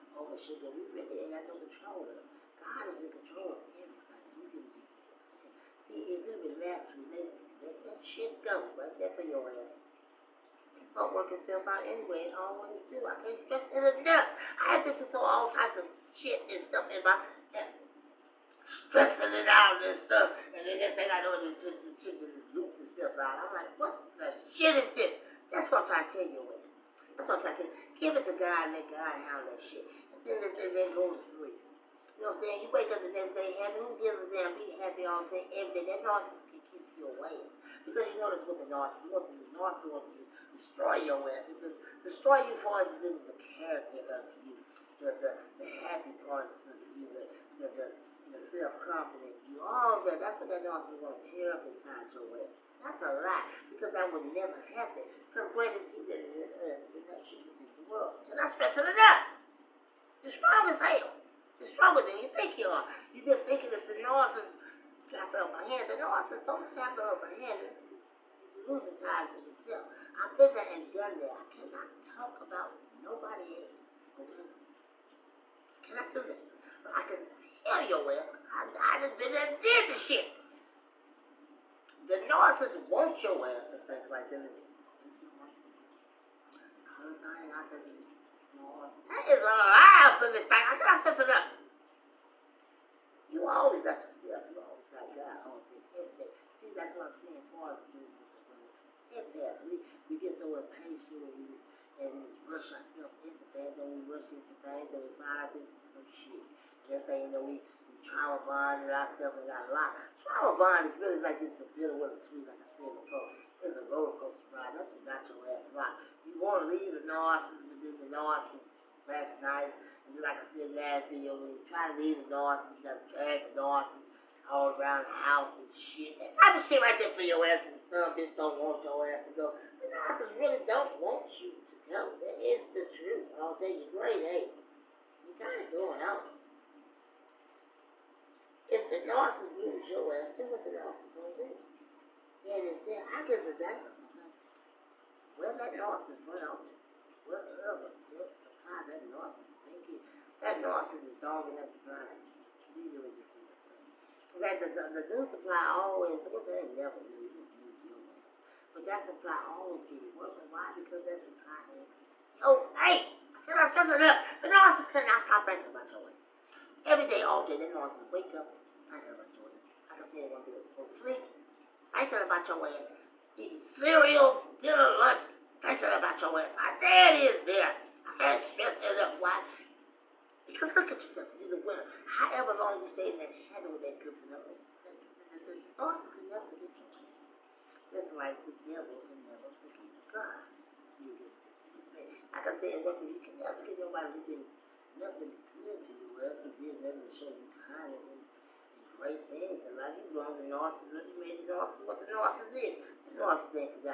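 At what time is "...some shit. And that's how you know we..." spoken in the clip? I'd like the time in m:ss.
1:45.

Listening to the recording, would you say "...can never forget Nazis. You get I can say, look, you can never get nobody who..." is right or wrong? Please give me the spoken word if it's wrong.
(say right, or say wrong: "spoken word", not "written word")
wrong: "God", not "Nazis".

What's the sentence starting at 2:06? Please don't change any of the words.
That type of shit right there for your ass And some bitch don't want your ass to go.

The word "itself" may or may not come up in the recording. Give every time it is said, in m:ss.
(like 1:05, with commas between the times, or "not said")
0:11, 0:22.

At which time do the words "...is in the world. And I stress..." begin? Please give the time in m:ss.
0:57.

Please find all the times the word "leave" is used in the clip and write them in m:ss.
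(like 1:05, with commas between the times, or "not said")
1:56, 2:01.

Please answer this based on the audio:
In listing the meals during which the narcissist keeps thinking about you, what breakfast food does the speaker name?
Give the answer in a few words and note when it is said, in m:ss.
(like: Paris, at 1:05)
cereal, at 2:53.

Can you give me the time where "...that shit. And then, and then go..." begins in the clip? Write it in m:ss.
0:29.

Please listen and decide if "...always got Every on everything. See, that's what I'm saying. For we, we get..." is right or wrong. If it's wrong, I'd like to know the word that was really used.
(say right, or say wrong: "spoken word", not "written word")
wrong: "God", not "Every".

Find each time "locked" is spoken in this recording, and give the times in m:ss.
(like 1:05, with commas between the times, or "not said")
1:49, 1:55.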